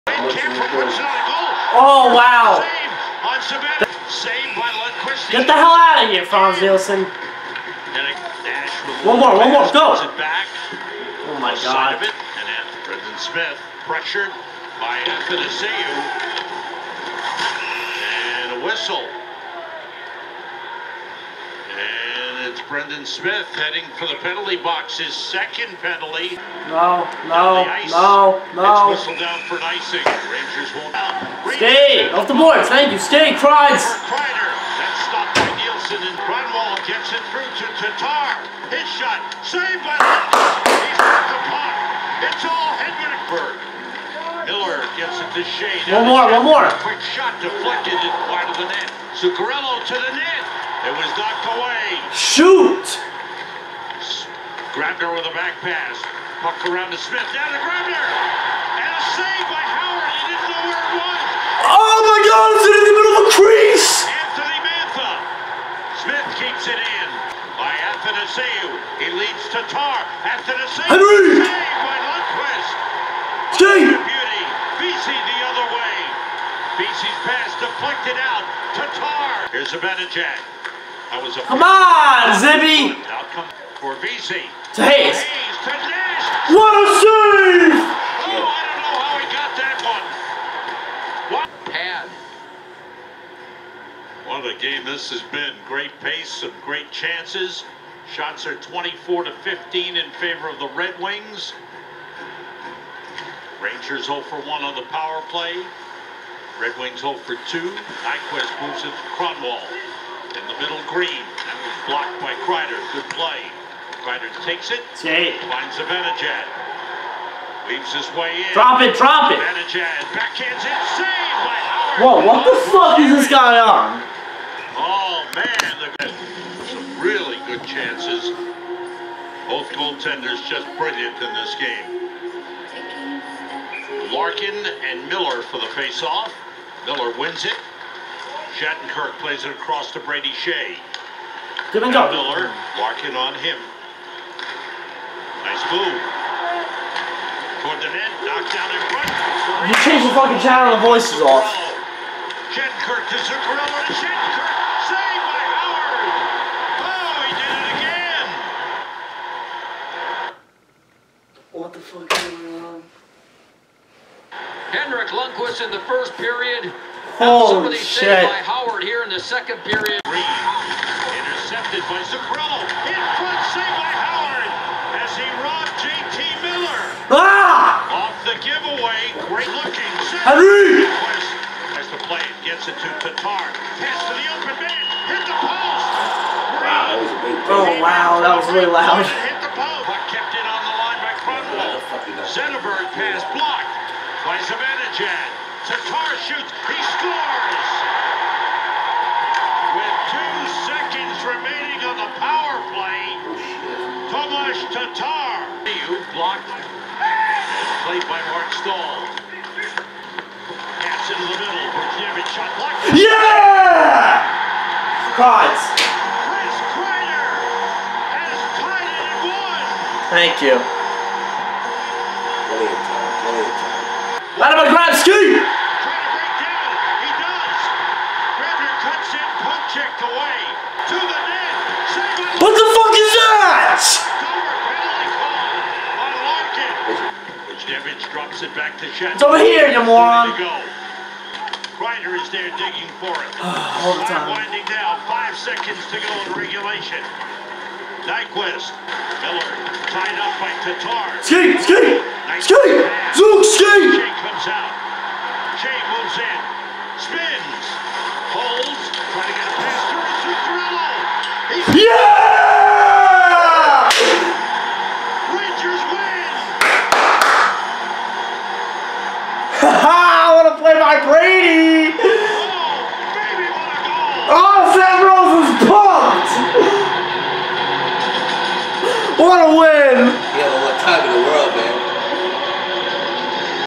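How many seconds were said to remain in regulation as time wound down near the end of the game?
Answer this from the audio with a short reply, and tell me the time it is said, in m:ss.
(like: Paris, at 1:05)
5, at 4:05.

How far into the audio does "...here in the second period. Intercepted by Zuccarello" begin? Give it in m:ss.
2:48.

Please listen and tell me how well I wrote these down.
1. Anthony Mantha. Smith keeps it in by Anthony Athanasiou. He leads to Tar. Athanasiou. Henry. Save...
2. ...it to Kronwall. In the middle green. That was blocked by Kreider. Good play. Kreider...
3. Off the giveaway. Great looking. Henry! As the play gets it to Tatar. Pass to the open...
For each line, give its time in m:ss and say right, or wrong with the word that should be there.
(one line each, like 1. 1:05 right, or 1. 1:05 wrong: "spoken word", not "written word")
1. 1:04 right
2. 1:48 right
3. 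2:58 right.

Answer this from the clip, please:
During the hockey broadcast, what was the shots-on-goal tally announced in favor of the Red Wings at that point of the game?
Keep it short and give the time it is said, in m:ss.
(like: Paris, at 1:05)
24 to 15, at 1:38.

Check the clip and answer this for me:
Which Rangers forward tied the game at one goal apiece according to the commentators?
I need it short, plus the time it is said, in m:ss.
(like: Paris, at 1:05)
Chris Kreider, at 3:35.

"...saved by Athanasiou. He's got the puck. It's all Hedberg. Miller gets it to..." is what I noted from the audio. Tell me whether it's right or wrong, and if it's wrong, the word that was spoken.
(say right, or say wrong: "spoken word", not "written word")
wrong: "Lutz", not "Athanasiou".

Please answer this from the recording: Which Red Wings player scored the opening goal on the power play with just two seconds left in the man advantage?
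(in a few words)
Tomas Tatar.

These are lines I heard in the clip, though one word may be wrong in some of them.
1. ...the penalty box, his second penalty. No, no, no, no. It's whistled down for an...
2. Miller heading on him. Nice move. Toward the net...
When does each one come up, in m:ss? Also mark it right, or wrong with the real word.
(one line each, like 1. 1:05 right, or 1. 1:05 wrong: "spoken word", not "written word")
1. 0:24 right
2. 2:22 wrong: "walking", not "heading".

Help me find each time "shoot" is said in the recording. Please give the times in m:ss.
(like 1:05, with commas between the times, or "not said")
0:52, 3:16.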